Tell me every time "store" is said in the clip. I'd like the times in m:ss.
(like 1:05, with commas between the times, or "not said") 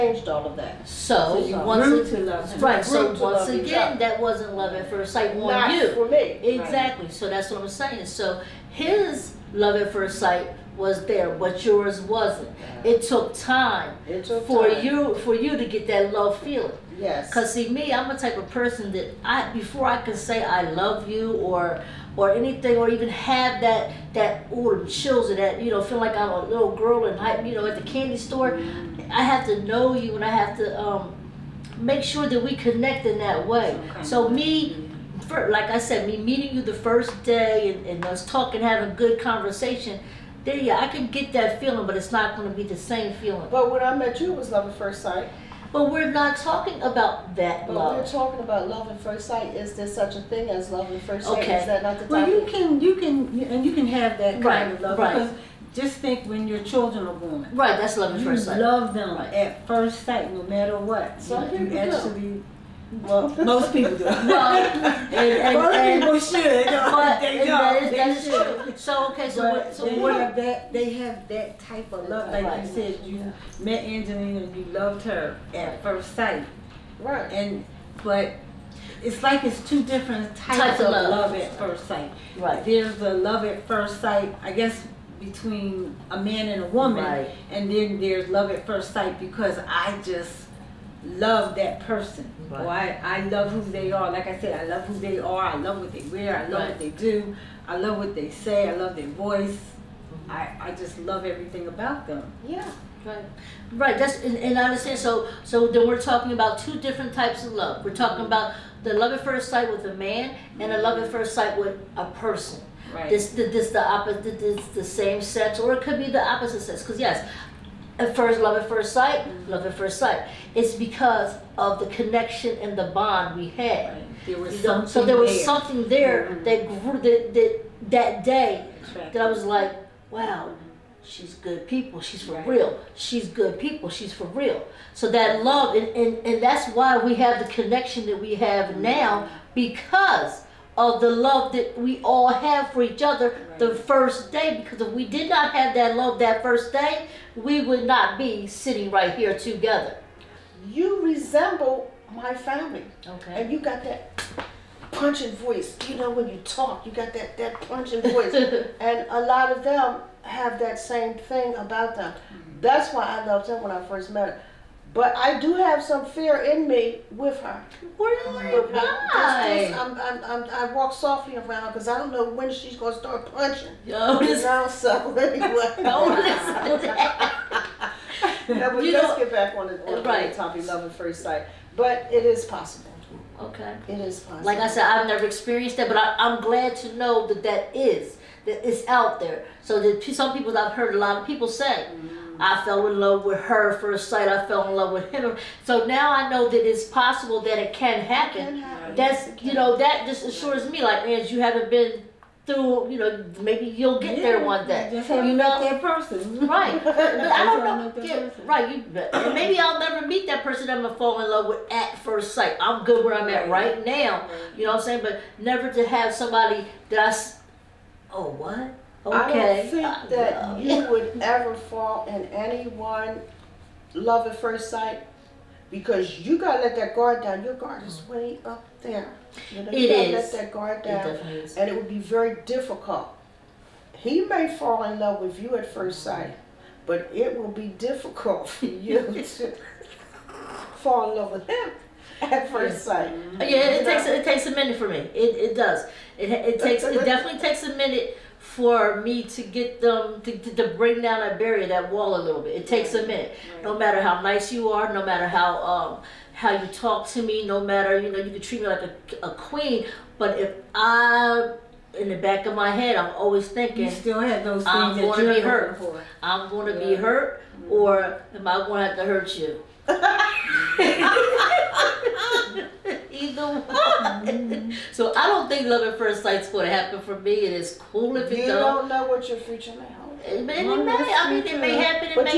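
0:28.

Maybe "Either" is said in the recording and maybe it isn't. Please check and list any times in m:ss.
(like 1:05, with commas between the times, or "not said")
4:33.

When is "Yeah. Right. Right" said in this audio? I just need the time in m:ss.
1:42.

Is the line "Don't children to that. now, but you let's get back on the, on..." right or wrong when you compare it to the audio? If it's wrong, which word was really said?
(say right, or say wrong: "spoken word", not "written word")
wrong: "listen", not "children".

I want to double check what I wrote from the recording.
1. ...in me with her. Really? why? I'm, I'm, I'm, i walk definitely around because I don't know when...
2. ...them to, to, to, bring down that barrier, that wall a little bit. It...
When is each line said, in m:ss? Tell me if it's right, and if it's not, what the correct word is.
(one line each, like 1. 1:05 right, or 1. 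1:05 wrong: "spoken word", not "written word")
1. 2:46 wrong: "softly", not "definitely"
2. 4:09 right.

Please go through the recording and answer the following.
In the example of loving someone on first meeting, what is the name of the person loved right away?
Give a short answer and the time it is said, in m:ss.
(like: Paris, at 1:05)
Angelina, at 1:13.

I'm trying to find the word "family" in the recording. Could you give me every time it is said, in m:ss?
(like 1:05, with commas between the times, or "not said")
2:32.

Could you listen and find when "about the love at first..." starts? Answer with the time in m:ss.
1:48.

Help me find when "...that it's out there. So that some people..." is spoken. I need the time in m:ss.
3:08.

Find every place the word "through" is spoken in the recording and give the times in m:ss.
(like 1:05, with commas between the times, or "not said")
3:22.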